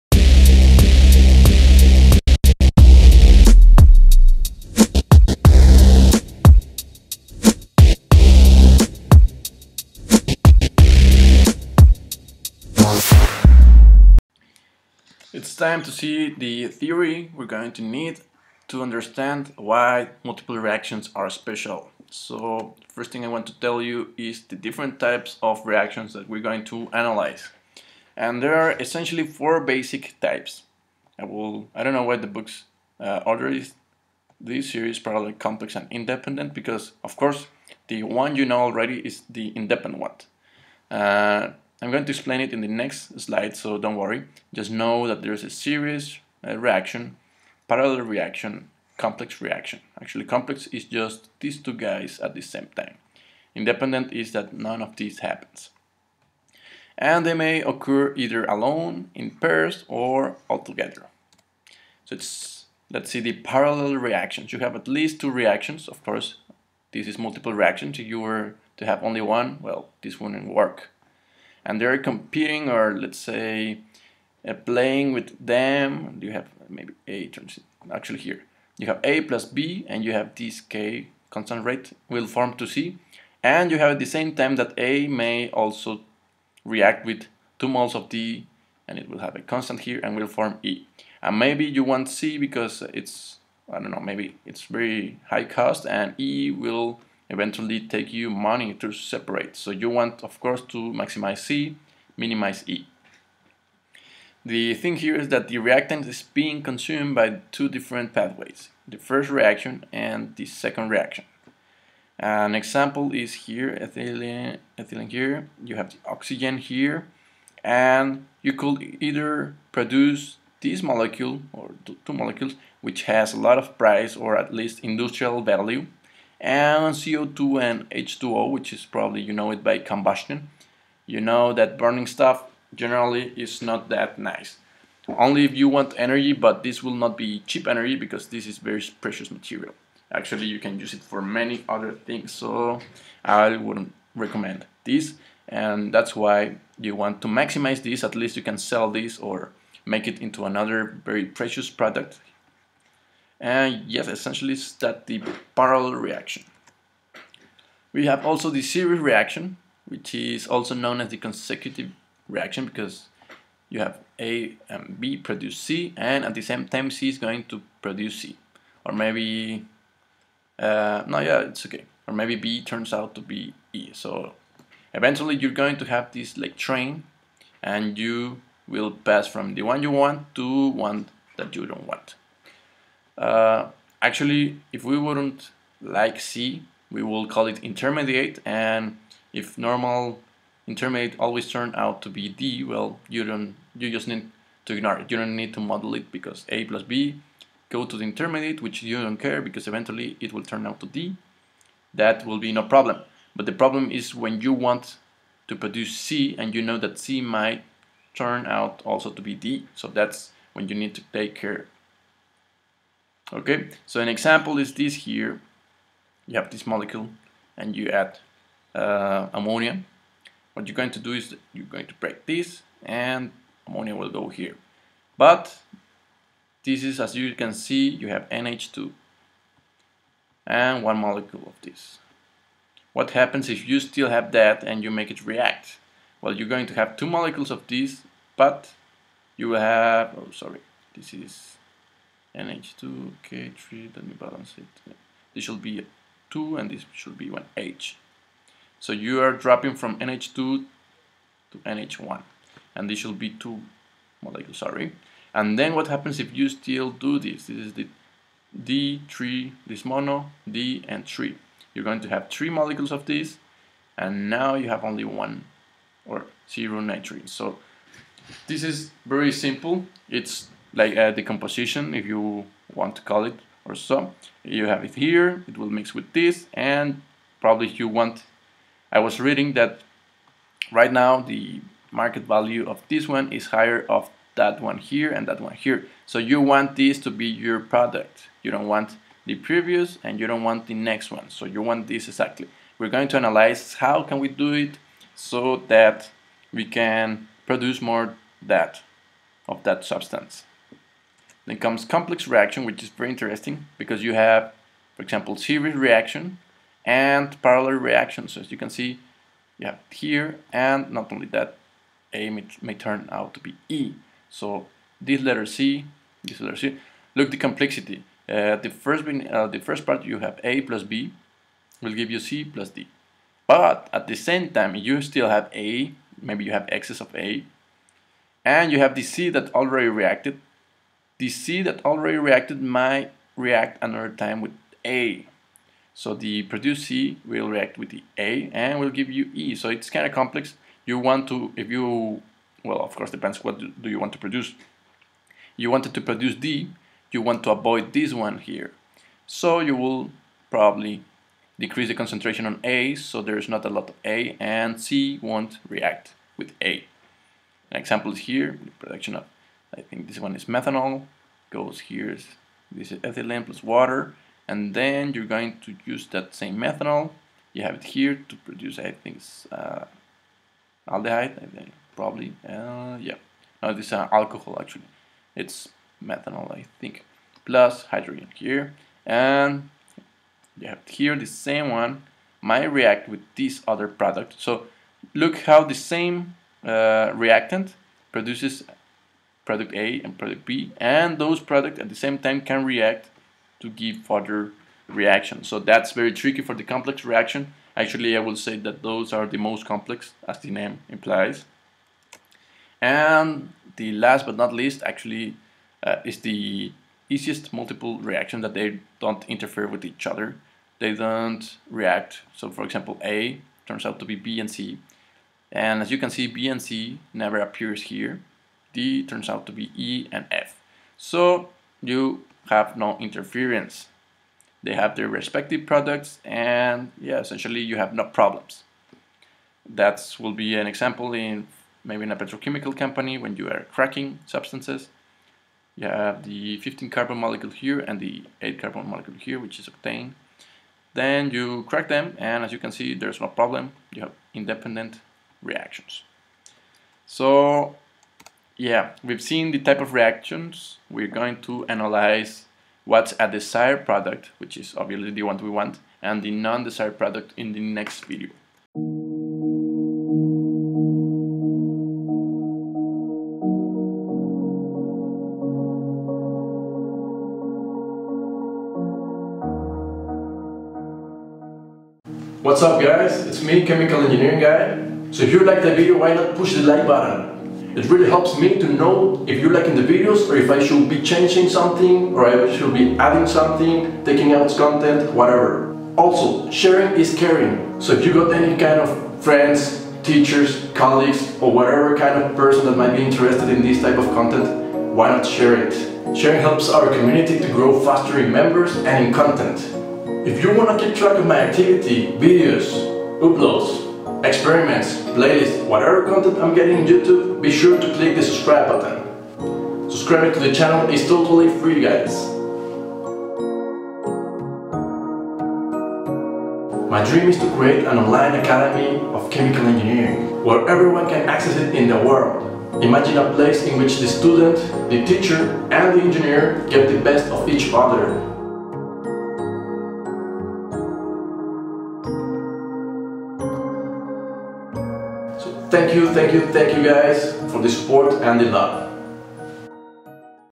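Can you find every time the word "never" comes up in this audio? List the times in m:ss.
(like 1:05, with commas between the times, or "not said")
6:57.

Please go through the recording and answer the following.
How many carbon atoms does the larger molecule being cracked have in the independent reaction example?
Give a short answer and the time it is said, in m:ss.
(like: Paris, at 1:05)
15, at 7:16.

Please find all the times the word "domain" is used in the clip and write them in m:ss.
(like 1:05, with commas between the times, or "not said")
not said.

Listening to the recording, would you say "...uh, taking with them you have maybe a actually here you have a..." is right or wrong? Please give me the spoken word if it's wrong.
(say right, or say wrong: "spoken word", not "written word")
wrong: "playing", not "taking".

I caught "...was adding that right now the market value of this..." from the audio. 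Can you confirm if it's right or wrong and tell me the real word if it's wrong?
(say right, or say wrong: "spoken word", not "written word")
wrong: "reading", not "adding".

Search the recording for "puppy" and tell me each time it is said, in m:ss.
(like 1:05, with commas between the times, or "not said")
not said.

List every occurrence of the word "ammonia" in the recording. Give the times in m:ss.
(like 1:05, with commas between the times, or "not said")
3:39, 3:43.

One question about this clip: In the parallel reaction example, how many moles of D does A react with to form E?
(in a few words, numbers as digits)
2.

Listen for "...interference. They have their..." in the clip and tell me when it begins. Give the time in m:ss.
7:02.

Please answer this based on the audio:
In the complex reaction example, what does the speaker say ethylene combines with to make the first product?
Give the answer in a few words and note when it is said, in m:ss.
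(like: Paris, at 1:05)
Water, at 6:03.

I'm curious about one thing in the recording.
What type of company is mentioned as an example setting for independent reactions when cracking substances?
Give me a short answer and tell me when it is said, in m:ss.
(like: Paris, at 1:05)
Petrochemical company, at 7:12.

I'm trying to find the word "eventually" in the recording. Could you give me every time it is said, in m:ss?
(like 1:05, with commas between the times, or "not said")
1:37, 2:54, 3:19.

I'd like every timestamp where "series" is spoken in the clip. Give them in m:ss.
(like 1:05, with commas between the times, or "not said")
0:34, 0:45, 2:38, 5:05.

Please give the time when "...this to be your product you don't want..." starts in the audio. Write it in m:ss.
4:46.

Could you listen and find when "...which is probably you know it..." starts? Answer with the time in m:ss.
2:08.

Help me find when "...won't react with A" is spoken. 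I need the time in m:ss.
5:55.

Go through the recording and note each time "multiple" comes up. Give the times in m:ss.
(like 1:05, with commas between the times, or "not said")
0:20, 1:07, 6:47.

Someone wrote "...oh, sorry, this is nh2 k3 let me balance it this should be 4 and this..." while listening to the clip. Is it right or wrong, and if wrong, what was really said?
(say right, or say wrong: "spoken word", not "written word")
wrong: "2", not "4".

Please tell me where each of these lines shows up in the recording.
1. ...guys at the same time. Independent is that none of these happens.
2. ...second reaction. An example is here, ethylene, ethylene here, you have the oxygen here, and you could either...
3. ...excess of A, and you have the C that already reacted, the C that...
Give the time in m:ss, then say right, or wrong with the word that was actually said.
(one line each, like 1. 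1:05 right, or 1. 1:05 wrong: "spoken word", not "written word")
1. 0:51 right
2. 1:50 right
3. 5:26 right.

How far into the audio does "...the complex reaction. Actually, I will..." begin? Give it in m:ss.
6:36.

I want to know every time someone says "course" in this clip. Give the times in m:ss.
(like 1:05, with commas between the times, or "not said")
0:37, 1:06, 1:40, 5:42.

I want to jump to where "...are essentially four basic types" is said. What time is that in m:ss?
0:28.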